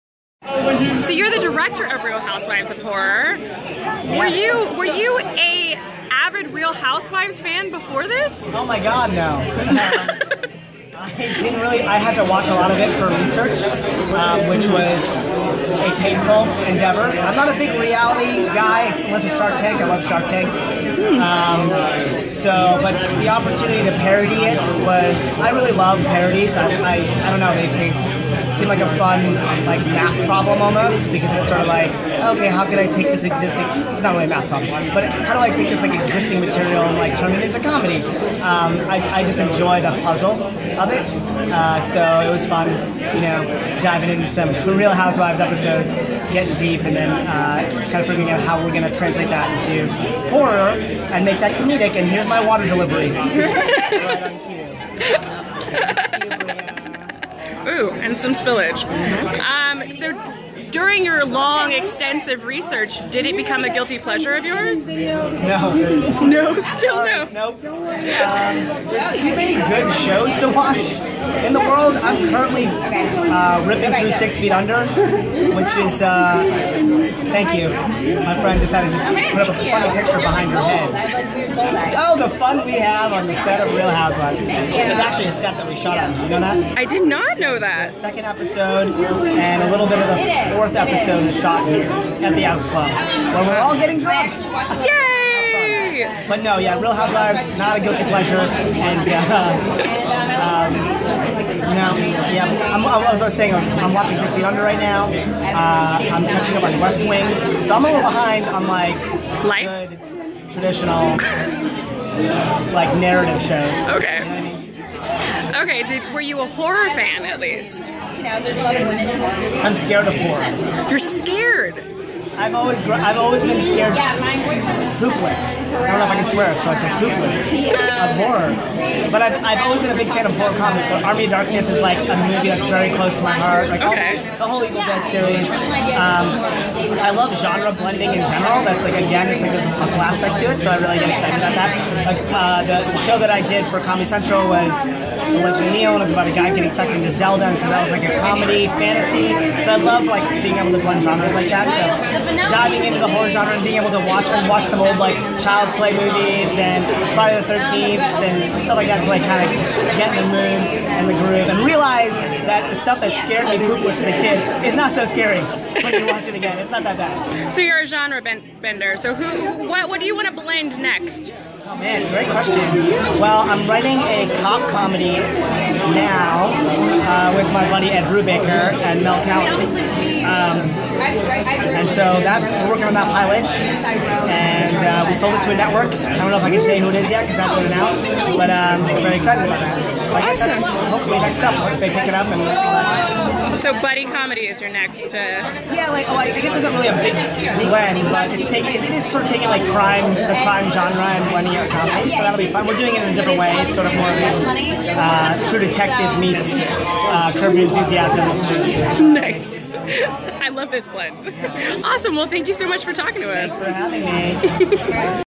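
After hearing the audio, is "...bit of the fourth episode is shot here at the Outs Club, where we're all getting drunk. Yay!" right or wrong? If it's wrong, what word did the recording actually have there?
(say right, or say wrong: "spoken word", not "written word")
right.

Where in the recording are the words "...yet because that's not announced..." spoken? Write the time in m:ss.
3:07.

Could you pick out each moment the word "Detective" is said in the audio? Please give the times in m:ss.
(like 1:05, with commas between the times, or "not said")
3:25.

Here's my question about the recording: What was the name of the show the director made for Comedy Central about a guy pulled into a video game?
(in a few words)
Legend of Neil.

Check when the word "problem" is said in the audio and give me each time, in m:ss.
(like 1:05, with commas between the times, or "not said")
0:30, 0:34.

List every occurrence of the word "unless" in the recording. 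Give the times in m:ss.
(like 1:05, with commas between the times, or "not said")
0:19.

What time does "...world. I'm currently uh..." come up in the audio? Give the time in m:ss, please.
1:11.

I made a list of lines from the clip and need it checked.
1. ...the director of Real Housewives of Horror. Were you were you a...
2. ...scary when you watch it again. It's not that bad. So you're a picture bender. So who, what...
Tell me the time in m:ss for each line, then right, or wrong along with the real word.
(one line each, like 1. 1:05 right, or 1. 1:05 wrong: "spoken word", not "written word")
1. 0:01 right
2. 2:45 wrong: "genre", not "picture".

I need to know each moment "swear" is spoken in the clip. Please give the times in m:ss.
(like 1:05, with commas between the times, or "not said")
2:06.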